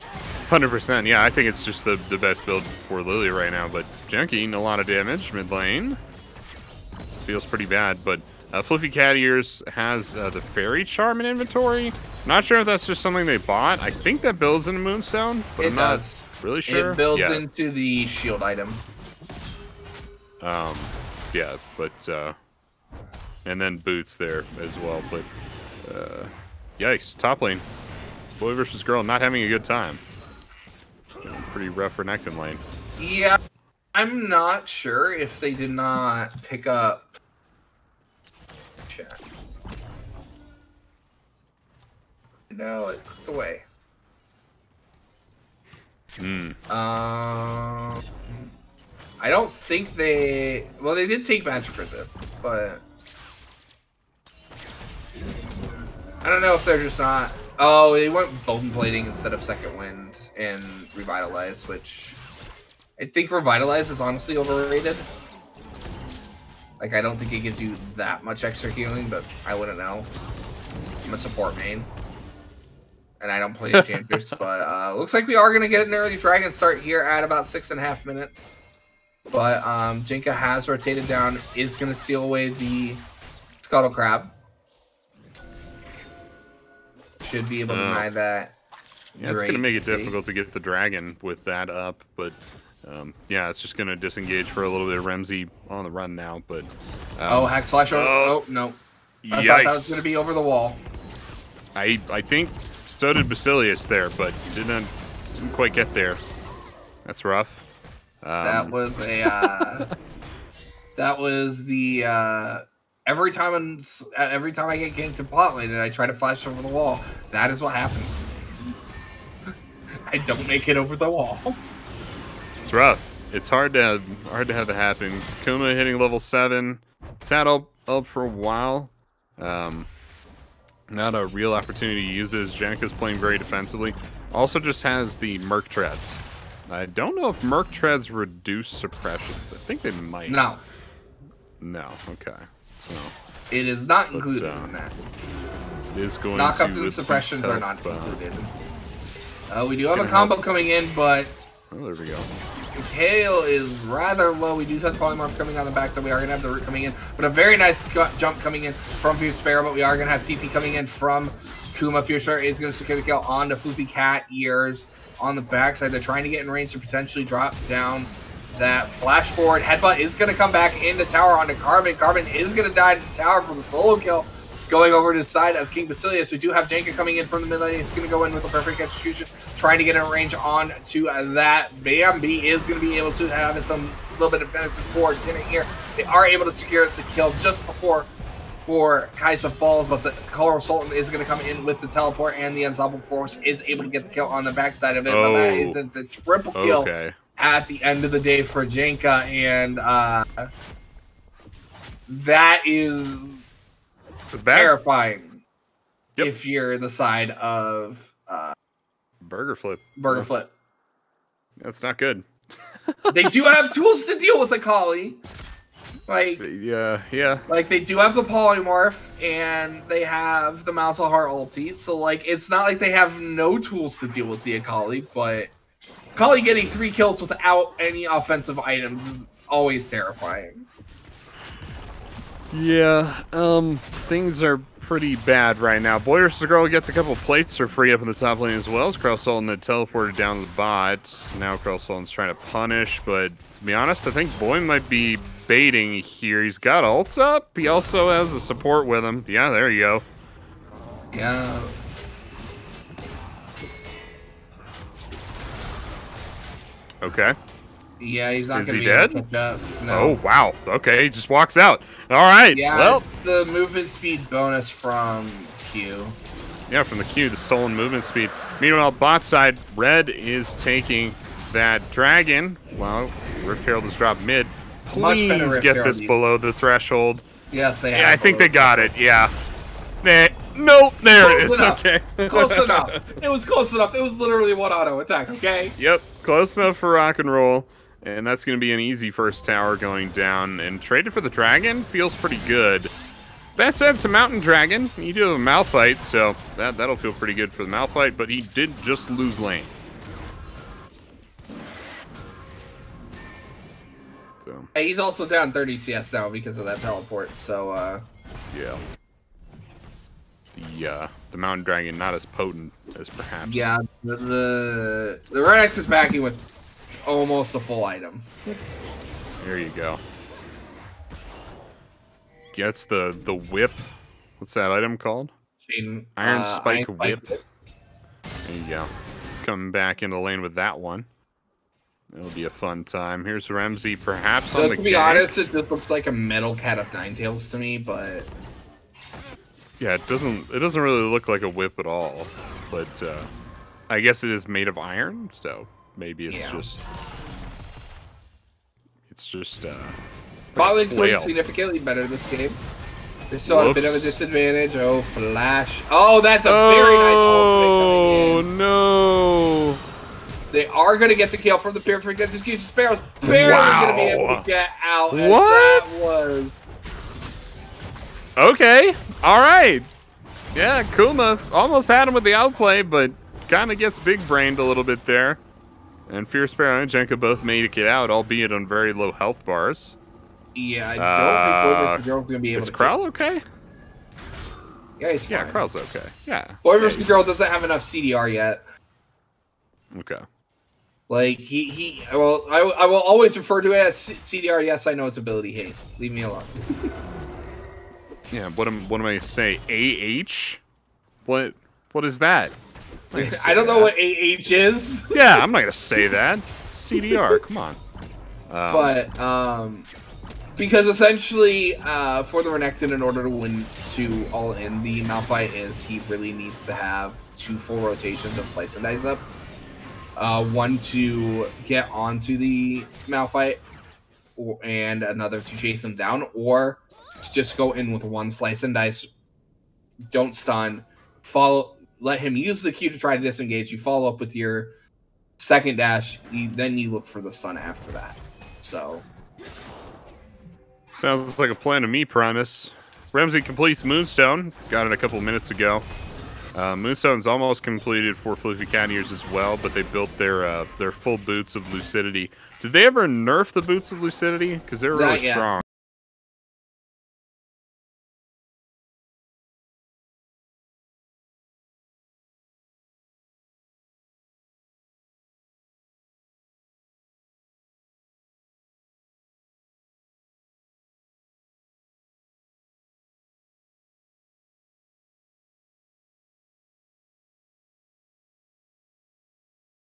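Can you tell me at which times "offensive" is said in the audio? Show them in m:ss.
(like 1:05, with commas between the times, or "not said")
3:48.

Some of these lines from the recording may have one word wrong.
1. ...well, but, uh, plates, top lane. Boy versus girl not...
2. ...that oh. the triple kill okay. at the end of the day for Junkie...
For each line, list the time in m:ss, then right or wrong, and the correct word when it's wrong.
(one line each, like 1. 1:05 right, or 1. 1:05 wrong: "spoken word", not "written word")
1. 0:24 wrong: "yikes", not "plates"
2. 3:15 wrong: "Jenka", not "Junkie".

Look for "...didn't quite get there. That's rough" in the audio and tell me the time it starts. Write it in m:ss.
1:45.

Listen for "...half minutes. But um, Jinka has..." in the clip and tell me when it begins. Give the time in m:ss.
1:17.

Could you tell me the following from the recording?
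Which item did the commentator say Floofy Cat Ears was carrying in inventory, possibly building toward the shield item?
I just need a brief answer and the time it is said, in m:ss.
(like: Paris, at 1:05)
Fairy Charm, at 0:10.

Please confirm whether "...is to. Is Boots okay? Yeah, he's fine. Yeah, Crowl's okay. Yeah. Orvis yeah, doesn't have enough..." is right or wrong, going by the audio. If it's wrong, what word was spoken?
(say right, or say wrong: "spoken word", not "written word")
wrong: "Crowl", not "Boots".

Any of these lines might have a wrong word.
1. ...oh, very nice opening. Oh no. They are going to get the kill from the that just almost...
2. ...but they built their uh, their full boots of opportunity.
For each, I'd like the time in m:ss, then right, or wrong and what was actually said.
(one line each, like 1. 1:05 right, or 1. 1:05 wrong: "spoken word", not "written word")
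1. 5:56 wrong: "against", not "almost"
2. 7:29 wrong: "lucidity", not "opportunity".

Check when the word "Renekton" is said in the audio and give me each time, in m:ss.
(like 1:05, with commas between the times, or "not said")
6:52.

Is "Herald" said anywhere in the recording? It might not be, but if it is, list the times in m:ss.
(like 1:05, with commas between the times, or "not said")
4:33.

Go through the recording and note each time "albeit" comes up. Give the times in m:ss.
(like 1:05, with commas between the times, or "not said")
6:18.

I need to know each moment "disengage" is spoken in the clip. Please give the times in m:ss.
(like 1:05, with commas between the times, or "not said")
1:33, 7:13.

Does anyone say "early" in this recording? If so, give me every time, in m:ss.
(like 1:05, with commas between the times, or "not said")
1:15.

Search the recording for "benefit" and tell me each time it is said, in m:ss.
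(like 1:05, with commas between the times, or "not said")
3:04.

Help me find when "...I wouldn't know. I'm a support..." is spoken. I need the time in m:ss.
1:09.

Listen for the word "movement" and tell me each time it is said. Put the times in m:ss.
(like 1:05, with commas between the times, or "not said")
4:23, 4:27.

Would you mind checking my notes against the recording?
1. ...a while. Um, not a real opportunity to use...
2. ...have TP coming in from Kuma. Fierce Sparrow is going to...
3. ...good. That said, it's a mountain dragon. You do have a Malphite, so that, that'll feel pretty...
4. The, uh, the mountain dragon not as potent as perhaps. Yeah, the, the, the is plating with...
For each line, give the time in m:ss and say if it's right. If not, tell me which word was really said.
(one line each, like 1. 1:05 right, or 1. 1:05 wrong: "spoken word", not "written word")
1. 2:08 right
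2. 2:40 right
3. 4:52 right
4. 5:10 wrong: "backing", not "plating".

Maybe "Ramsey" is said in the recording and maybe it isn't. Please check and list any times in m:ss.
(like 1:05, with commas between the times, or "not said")
1:35, 5:33, 7:23.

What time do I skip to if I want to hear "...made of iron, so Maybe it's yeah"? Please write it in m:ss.
5:44.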